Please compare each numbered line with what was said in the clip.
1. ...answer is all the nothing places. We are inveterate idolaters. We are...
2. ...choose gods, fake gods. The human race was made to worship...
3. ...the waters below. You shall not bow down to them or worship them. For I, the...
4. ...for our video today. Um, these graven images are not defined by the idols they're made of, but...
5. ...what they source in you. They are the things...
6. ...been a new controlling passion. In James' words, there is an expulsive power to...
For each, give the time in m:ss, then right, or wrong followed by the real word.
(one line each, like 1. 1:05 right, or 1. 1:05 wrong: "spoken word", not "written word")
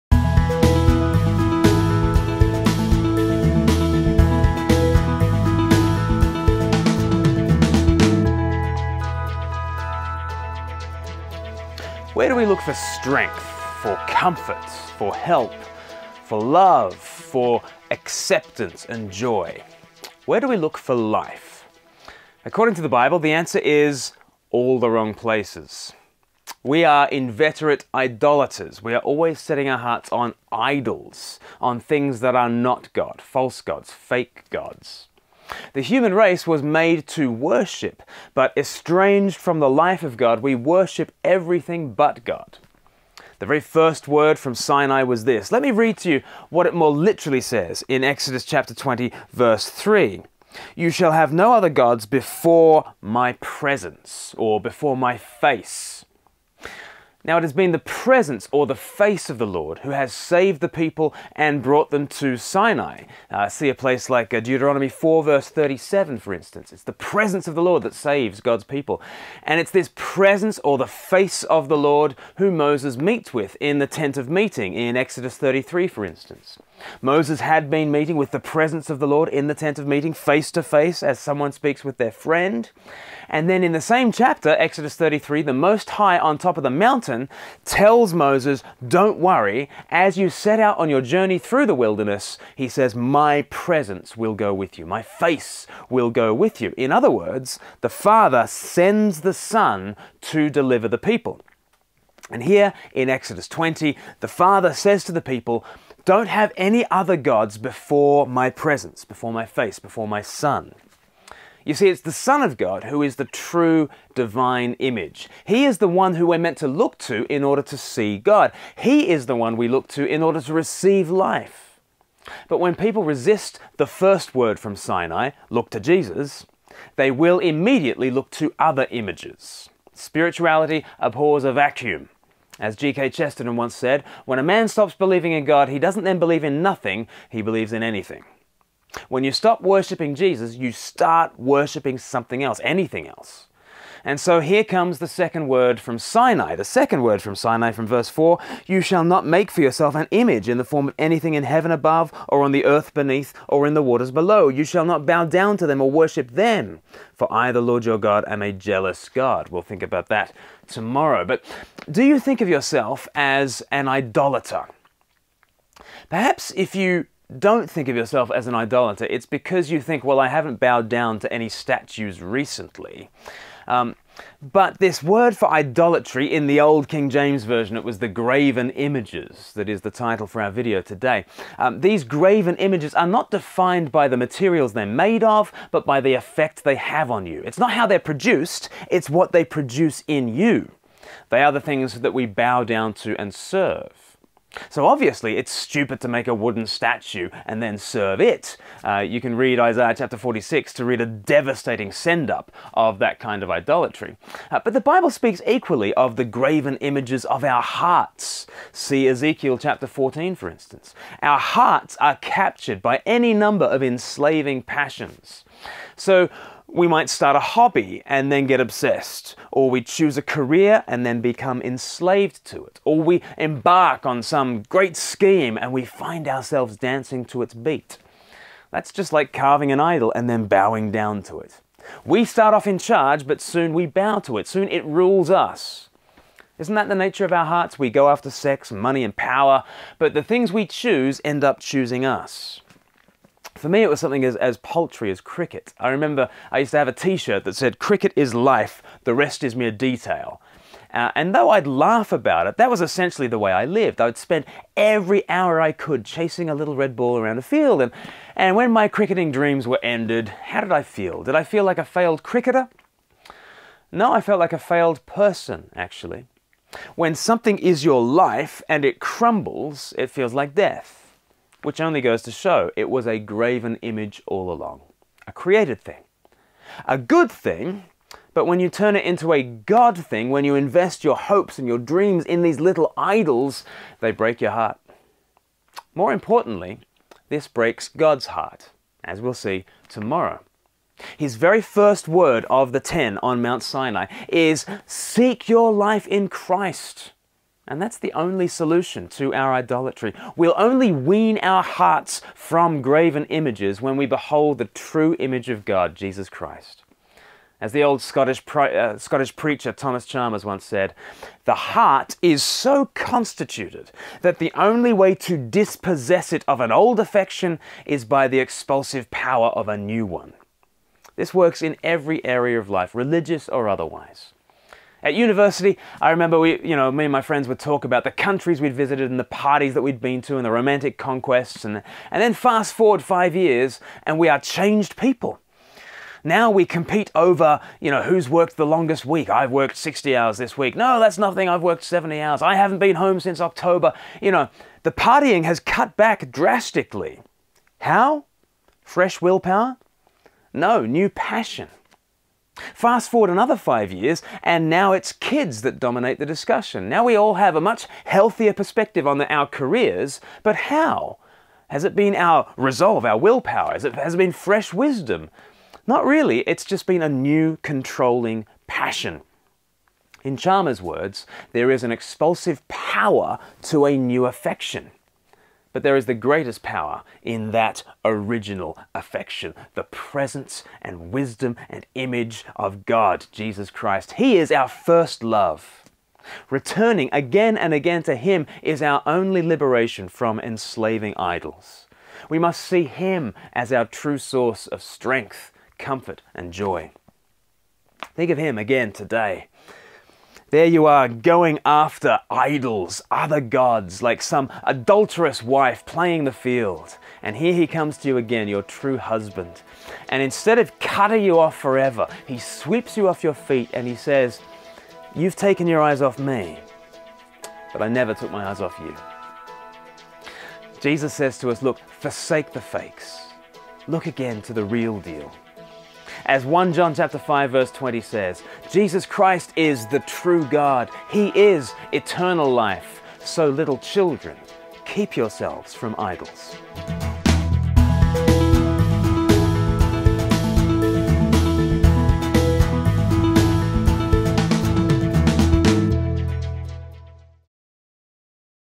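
1. 0:23 wrong: "wrong", not "nothing"
2. 0:33 wrong: "false", not "choose"
3. 2:33 right
4. 3:00 wrong: "materials", not "idols"
5. 3:09 wrong: "produce", not "source"
6. 6:06 wrong: "Chalmers", not "James".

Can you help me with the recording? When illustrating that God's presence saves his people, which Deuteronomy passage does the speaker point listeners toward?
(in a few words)
Deuteronomy 4:37.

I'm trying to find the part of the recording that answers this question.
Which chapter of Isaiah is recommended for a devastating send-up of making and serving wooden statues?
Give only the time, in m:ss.
3:19.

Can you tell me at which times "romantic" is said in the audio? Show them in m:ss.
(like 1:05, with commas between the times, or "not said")
5:30.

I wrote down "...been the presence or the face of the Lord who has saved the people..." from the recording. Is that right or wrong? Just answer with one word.
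right.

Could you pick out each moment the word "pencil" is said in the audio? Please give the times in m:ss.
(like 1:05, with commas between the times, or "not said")
not said.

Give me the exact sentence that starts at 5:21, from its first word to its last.
This works in every area of life, religious or otherwise.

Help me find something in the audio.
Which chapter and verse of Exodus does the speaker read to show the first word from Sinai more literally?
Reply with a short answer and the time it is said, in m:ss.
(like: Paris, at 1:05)
Exodus 20:3, at 0:48.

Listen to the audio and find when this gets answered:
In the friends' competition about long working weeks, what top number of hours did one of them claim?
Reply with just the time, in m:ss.
5:41.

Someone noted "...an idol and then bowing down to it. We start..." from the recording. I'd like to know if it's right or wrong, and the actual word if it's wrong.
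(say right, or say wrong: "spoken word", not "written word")
right.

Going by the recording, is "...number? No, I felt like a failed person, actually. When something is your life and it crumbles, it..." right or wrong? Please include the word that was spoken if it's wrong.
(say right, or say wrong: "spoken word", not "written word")
wrong: "cricketer", not "number".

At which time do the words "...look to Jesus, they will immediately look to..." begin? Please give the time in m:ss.
2:05.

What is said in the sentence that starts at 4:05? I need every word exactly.
I remember I used to have a t shirt that said, Cricket is life, the rest is mere detail.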